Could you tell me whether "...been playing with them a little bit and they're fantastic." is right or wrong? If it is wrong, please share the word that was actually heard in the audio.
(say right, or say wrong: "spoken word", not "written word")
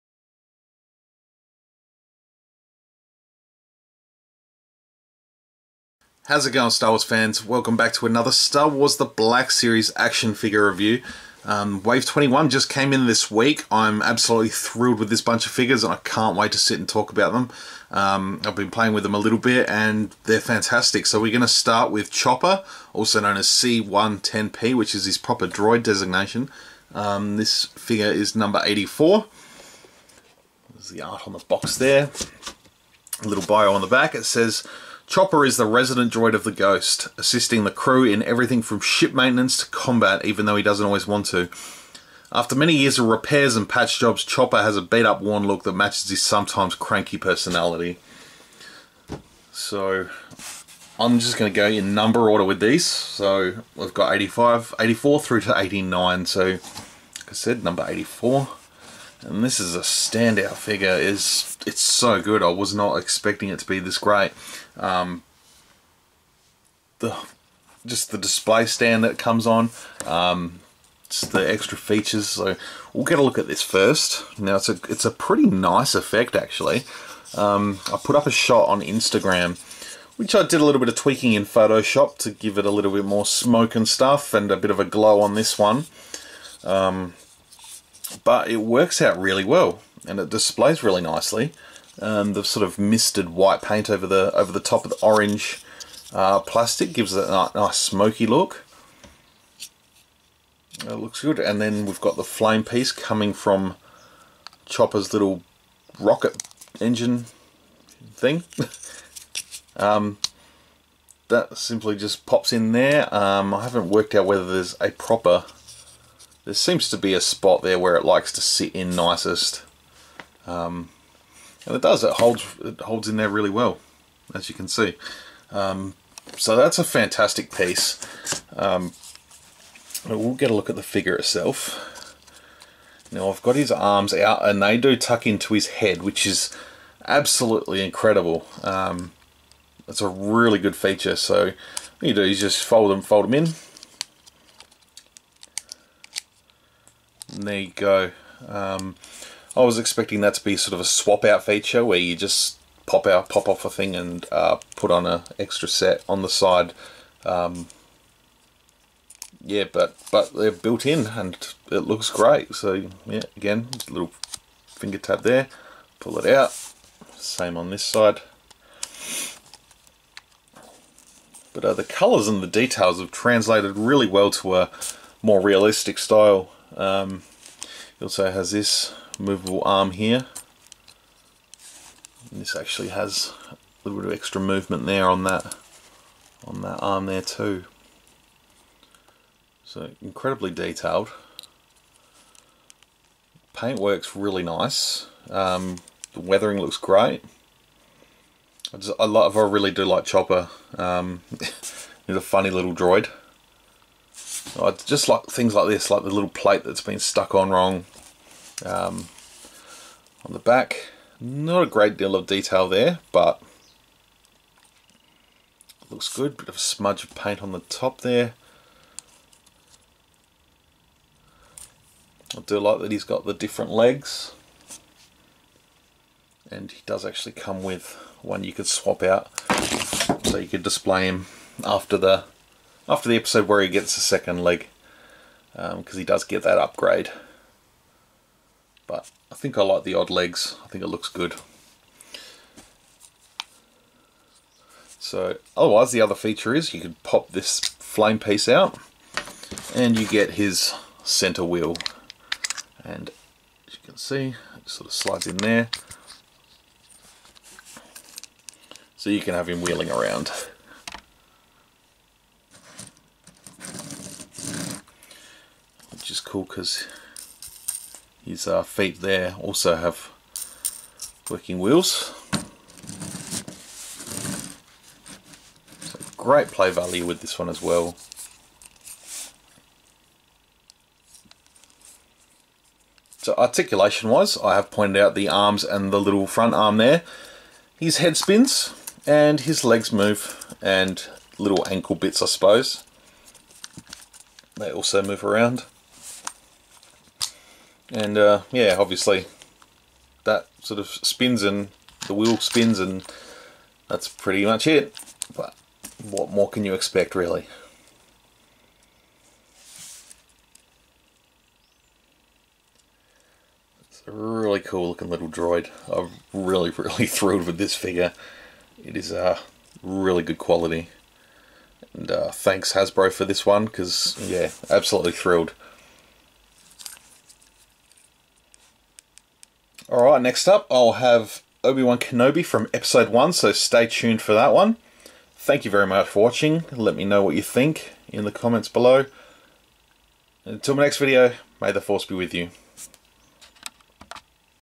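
right.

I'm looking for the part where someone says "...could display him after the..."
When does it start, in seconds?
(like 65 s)
230 s.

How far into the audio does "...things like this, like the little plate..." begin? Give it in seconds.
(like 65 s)
205 s.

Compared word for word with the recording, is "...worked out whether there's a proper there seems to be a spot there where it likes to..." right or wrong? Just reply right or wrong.
right.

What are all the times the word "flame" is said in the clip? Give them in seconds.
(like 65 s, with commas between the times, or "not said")
102 s, 247 s.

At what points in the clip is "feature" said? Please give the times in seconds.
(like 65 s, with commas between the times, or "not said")
71 s, 140 s, 151 s, 246 s.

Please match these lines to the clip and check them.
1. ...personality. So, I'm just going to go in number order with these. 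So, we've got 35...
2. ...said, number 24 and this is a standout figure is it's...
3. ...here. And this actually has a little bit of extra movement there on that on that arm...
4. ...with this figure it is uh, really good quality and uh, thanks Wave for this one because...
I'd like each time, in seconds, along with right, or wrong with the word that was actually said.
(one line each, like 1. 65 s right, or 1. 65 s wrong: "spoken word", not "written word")
1. 47 s wrong: "85", not "35"
2. 57 s wrong: "84", not "24"
3. 179 s right
4. 317 s wrong: "Hasbro", not "Wave".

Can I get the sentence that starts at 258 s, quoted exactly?
So you can have him wheeling around.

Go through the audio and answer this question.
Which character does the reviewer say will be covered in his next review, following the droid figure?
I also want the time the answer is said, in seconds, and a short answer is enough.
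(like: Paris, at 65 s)
Obi-Wan Kenobi, at 331 s.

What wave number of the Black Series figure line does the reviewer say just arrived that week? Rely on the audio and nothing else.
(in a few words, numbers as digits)
21.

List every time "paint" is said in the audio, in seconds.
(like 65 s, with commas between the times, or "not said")
93 s, 193 s, 217 s.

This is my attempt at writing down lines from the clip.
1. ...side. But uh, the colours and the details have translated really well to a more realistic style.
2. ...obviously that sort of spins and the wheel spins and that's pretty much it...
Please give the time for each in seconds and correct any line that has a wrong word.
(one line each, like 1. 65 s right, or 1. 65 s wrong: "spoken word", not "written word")
1. 167 s right
2. 298 s right.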